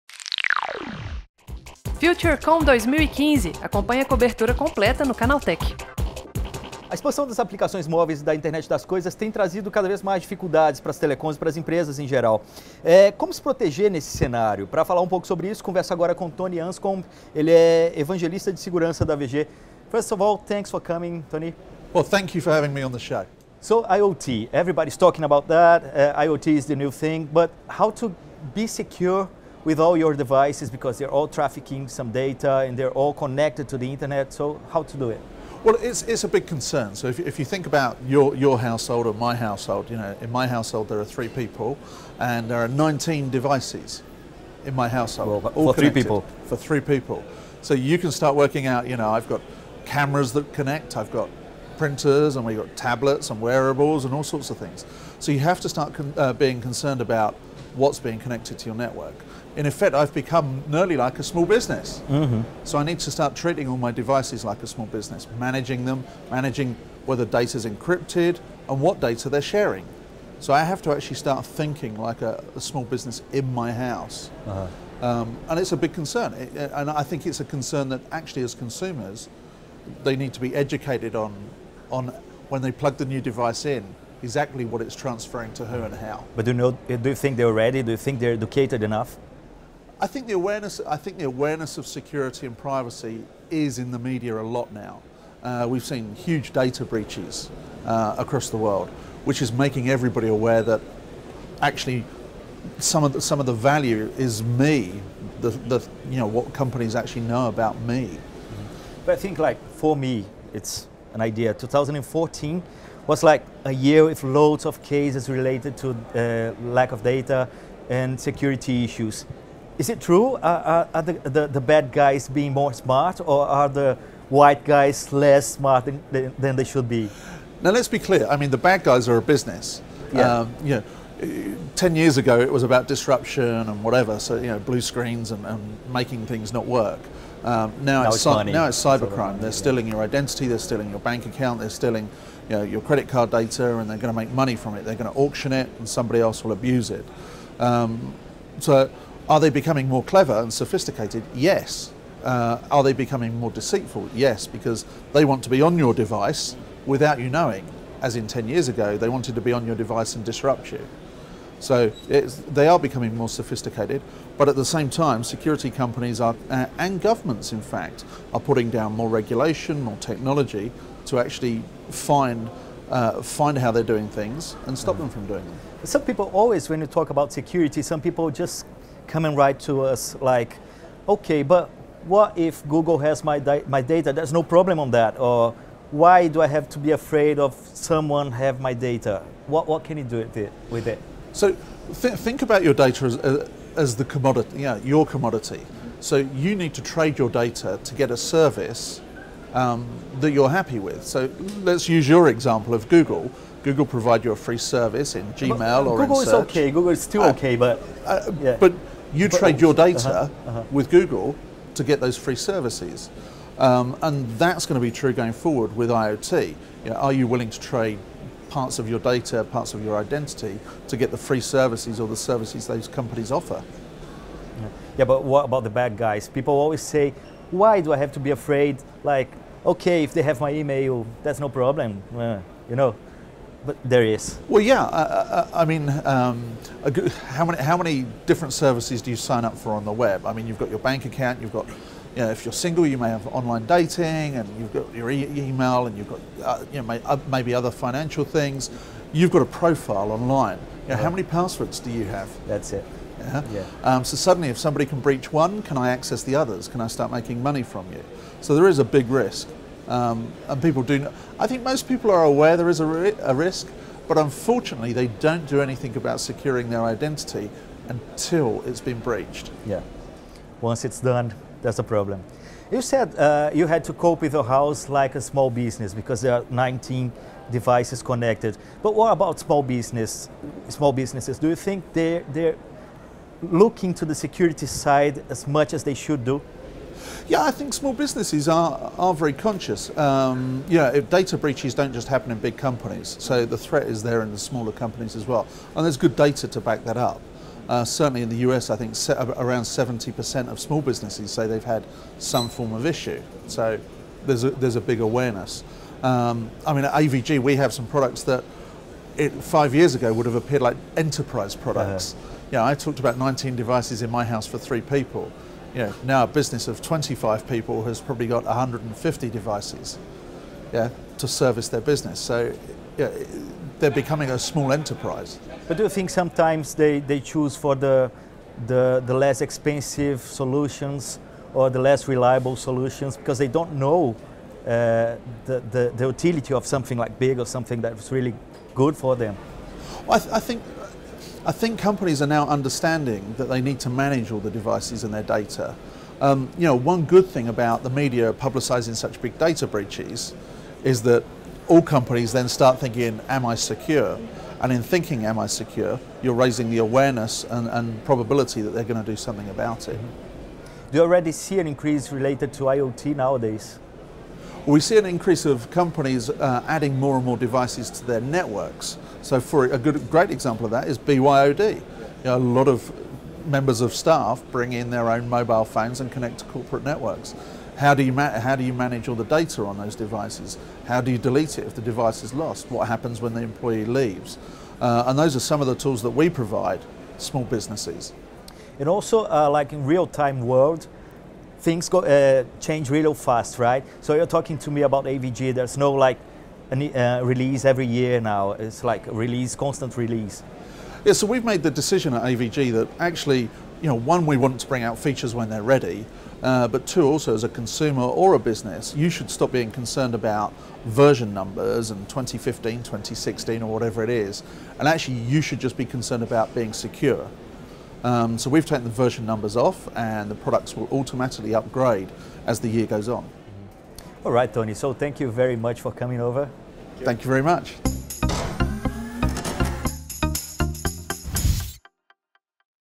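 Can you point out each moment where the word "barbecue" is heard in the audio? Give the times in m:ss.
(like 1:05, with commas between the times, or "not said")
not said.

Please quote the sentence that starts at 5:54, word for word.
And in thinking, am I secure, you're raising the awareness and, and probability that they're going to do something about it.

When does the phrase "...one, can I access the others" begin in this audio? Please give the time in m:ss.
4:15.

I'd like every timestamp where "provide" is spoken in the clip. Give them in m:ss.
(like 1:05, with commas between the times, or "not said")
3:23, 6:26.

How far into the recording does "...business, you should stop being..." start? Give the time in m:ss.
6:48.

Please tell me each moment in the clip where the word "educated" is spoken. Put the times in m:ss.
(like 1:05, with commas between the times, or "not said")
1:20, 1:28.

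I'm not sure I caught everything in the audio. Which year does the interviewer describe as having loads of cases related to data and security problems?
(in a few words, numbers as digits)
2014.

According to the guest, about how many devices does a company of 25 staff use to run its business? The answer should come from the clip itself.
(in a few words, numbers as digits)
150.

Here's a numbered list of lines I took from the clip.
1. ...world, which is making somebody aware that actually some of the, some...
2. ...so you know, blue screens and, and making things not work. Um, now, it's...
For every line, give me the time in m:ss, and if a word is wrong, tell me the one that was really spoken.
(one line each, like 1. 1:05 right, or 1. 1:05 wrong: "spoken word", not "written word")
1. 1:38 wrong: "everybody", not "somebody"
2. 2:14 right.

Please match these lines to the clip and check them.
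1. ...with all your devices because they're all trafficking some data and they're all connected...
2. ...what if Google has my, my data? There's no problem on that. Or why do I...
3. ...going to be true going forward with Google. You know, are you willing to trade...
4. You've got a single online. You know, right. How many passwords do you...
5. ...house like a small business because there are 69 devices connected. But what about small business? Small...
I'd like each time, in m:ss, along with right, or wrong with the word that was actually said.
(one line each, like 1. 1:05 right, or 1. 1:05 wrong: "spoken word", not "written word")
1. 0:29 right
2. 3:02 right
3. 3:34 wrong: "IoT", not "Google"
4. 4:09 wrong: "profile", not "single"
5. 4:34 wrong: "19", not "69".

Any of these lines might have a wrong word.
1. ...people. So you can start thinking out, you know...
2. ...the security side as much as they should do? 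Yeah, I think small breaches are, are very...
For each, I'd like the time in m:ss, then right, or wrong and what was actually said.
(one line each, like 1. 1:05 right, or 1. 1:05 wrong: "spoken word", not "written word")
1. 0:46 wrong: "working", not "thinking"
2. 4:44 wrong: "businesses", not "breaches".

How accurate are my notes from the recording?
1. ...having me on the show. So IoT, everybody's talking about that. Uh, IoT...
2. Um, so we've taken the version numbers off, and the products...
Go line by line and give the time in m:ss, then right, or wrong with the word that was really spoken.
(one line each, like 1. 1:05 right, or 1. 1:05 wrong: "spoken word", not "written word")
1. 0:22 right
2. 6:58 right.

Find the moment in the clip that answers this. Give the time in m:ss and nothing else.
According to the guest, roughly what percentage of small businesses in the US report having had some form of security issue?
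4:59.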